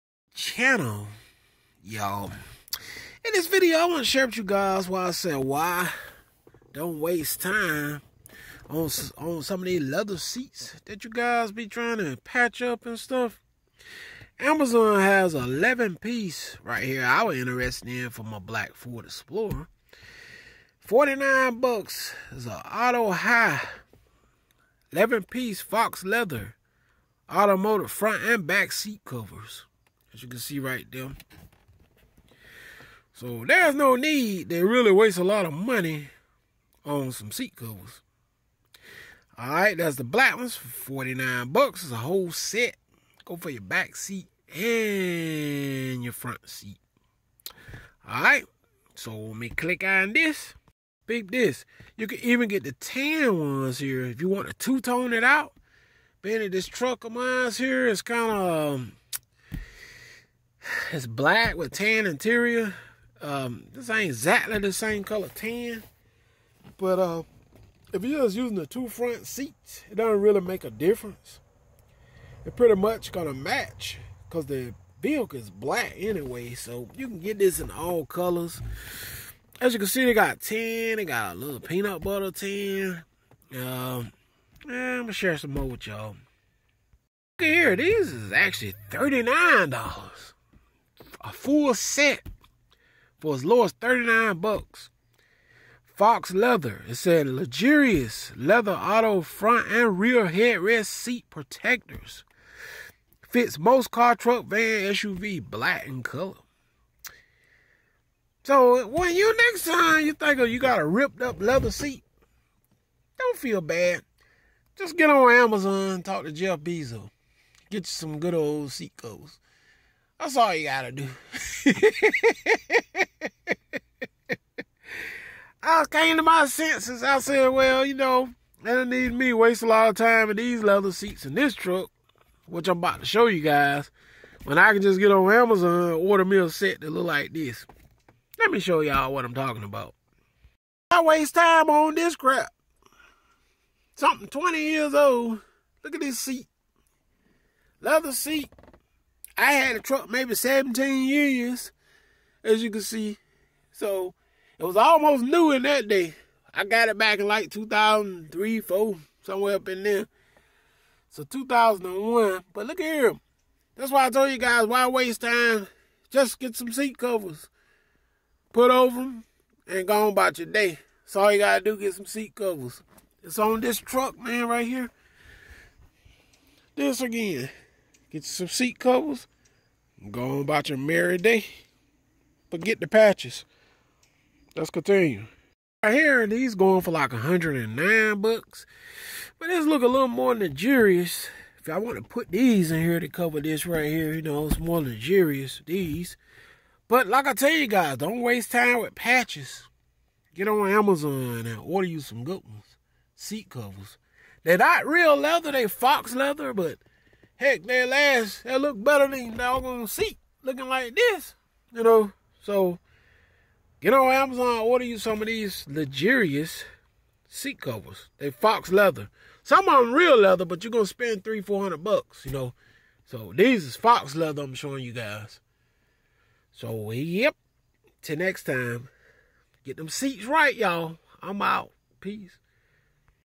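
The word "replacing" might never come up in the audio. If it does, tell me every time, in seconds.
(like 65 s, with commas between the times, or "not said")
not said.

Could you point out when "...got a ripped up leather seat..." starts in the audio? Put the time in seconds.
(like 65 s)
110 s.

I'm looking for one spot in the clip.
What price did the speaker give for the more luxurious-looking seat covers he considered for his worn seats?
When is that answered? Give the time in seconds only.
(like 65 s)
187 s.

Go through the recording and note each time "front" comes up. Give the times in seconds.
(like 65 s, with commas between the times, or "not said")
27 s, 46 s, 68 s, 99 s.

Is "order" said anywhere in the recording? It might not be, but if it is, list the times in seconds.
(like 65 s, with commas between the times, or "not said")
135 s, 201 s, 214 s.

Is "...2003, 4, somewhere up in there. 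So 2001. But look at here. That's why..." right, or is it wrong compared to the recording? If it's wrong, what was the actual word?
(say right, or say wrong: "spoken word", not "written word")
right.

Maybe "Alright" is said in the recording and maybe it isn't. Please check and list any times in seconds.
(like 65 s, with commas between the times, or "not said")
39 s, 48 s.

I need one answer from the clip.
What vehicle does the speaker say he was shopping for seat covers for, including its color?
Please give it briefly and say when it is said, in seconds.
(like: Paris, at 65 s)
Black Ford Explorer, at 18 s.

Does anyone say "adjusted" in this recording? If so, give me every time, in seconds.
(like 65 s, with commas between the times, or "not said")
not said.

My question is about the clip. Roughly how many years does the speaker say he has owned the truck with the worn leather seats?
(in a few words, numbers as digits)
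17 years.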